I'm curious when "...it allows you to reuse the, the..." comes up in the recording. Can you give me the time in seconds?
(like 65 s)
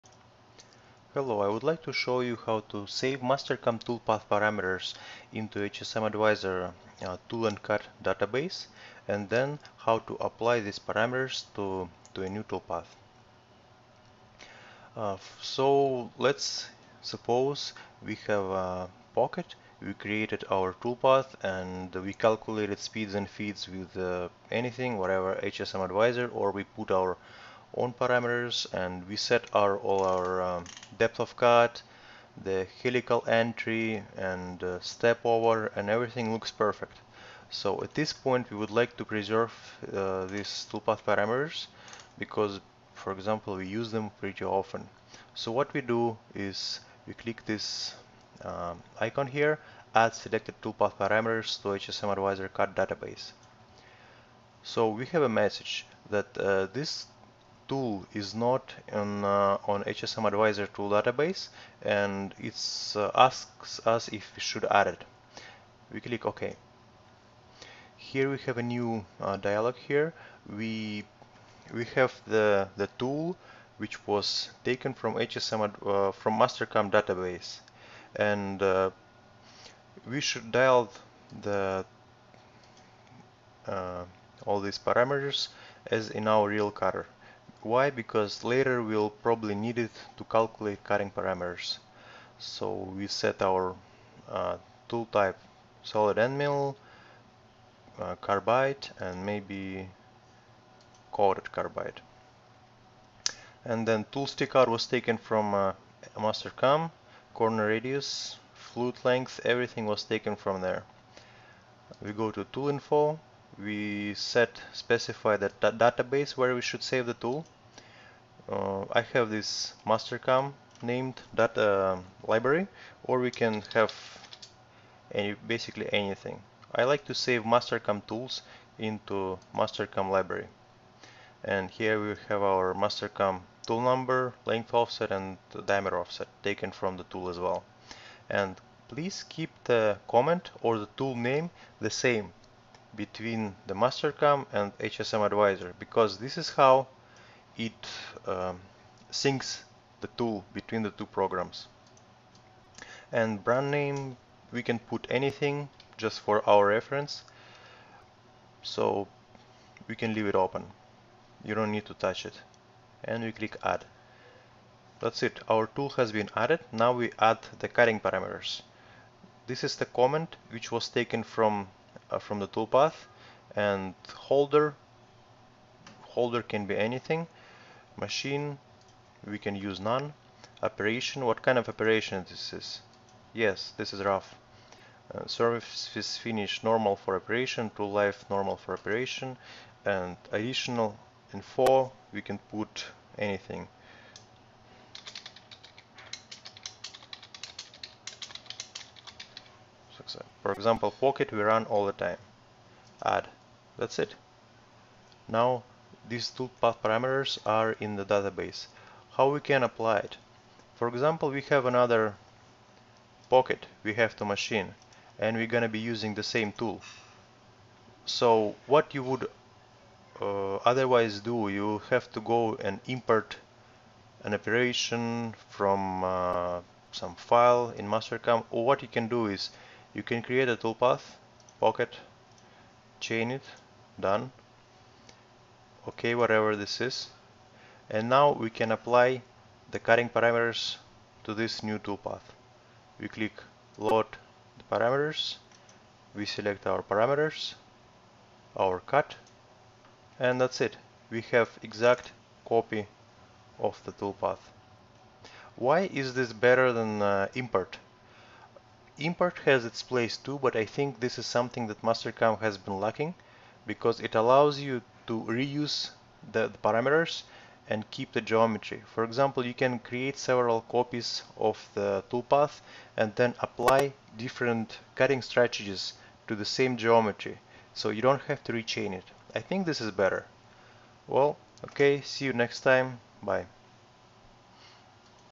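263 s.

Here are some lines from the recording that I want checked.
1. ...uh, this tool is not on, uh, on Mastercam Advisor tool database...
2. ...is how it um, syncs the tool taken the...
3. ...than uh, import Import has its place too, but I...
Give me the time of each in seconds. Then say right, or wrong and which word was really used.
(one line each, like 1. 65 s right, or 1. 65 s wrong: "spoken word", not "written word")
1. 56 s wrong: "HSM", not "Mastercam"
2. 146 s wrong: "between", not "taken"
3. 256 s right.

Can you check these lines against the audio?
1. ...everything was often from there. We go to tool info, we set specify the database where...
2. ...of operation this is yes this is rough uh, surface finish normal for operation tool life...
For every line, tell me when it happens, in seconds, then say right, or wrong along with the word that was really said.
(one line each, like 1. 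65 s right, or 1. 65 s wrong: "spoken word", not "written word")
1. 109 s wrong: "taken", not "often"
2. 181 s right.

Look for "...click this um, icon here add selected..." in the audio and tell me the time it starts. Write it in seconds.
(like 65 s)
47 s.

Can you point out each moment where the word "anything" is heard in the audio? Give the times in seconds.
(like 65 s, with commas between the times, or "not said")
24 s, 125 s, 155 s, 176 s, 193 s.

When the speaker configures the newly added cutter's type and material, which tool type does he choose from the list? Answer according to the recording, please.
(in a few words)
Solid end mill.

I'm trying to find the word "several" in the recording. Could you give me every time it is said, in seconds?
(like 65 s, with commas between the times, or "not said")
270 s.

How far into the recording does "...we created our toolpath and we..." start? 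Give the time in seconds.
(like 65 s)
19 s.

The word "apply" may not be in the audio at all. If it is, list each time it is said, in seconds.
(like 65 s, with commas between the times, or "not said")
10 s, 209 s, 238 s, 273 s.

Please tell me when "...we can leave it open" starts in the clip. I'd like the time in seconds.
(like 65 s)
159 s.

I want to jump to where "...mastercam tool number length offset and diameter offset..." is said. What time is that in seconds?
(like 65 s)
132 s.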